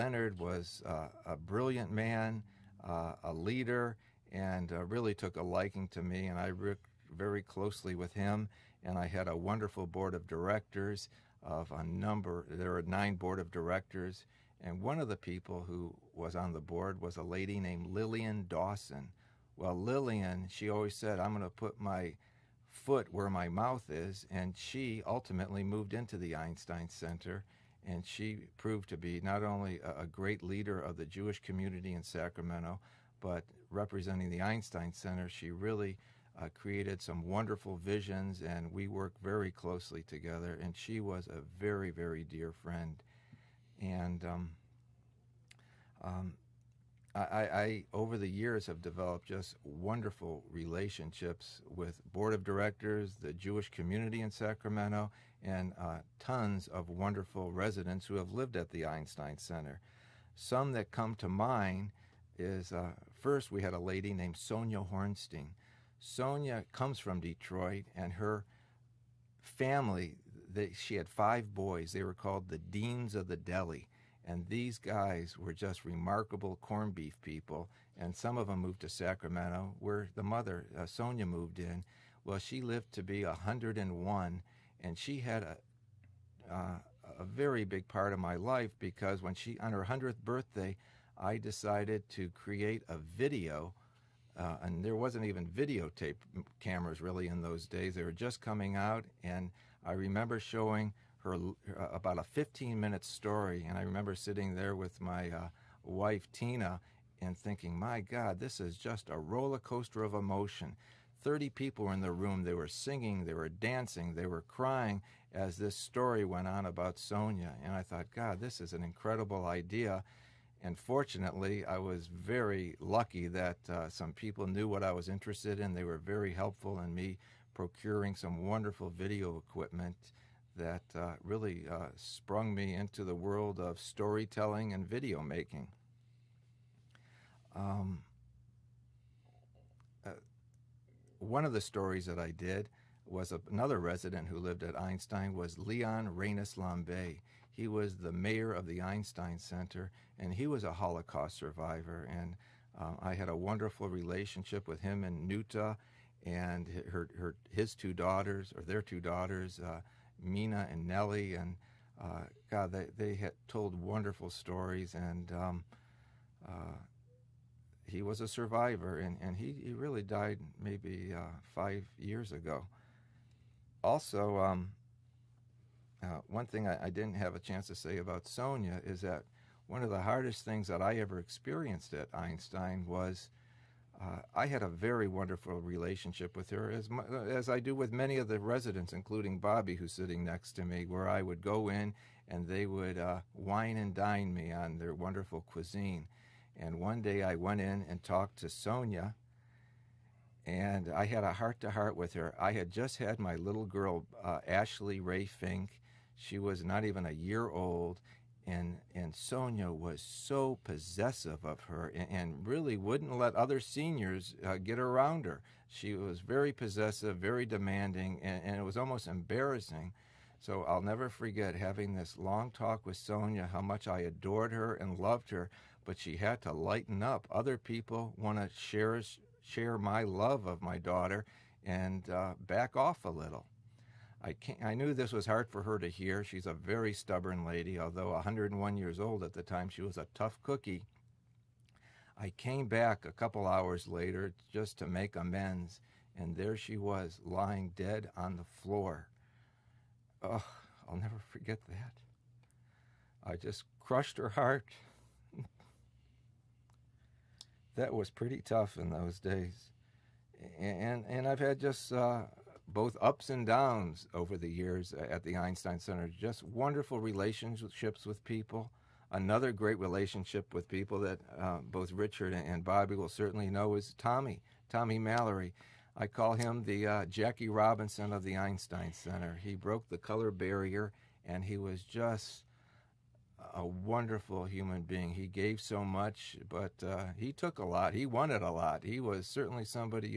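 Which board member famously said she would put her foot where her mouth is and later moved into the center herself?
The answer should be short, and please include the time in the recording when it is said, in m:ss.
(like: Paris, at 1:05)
Lillian Dawson, at 0:17.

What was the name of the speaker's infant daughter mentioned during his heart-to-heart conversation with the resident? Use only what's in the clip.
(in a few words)
Ashley Ray Finke.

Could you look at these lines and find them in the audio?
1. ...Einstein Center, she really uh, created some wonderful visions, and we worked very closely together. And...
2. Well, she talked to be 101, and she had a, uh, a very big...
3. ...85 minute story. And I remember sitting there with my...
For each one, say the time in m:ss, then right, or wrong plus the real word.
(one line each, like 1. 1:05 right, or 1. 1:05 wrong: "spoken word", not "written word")
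1. 0:34 right
2. 1:22 wrong: "lived", not "talked"
3. 1:42 wrong: "15", not "85".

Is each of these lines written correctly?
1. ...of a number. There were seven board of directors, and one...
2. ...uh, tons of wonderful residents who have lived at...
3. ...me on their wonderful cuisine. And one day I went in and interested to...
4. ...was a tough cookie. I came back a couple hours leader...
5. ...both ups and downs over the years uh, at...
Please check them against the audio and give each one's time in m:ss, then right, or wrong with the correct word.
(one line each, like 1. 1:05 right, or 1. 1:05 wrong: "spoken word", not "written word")
1. 0:11 wrong: "nine", not "seven"
2. 0:55 right
3. 3:14 wrong: "talked", not "interested"
4. 3:59 wrong: "later", not "leader"
5. 4:22 right.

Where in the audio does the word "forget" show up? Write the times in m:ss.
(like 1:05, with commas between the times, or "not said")
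3:41, 4:11.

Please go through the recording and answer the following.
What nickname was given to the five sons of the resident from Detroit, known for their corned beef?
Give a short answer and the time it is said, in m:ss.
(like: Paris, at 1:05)
Deans of the Deli, at 1:12.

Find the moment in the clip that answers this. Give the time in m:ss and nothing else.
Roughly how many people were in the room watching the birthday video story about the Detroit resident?
1:51.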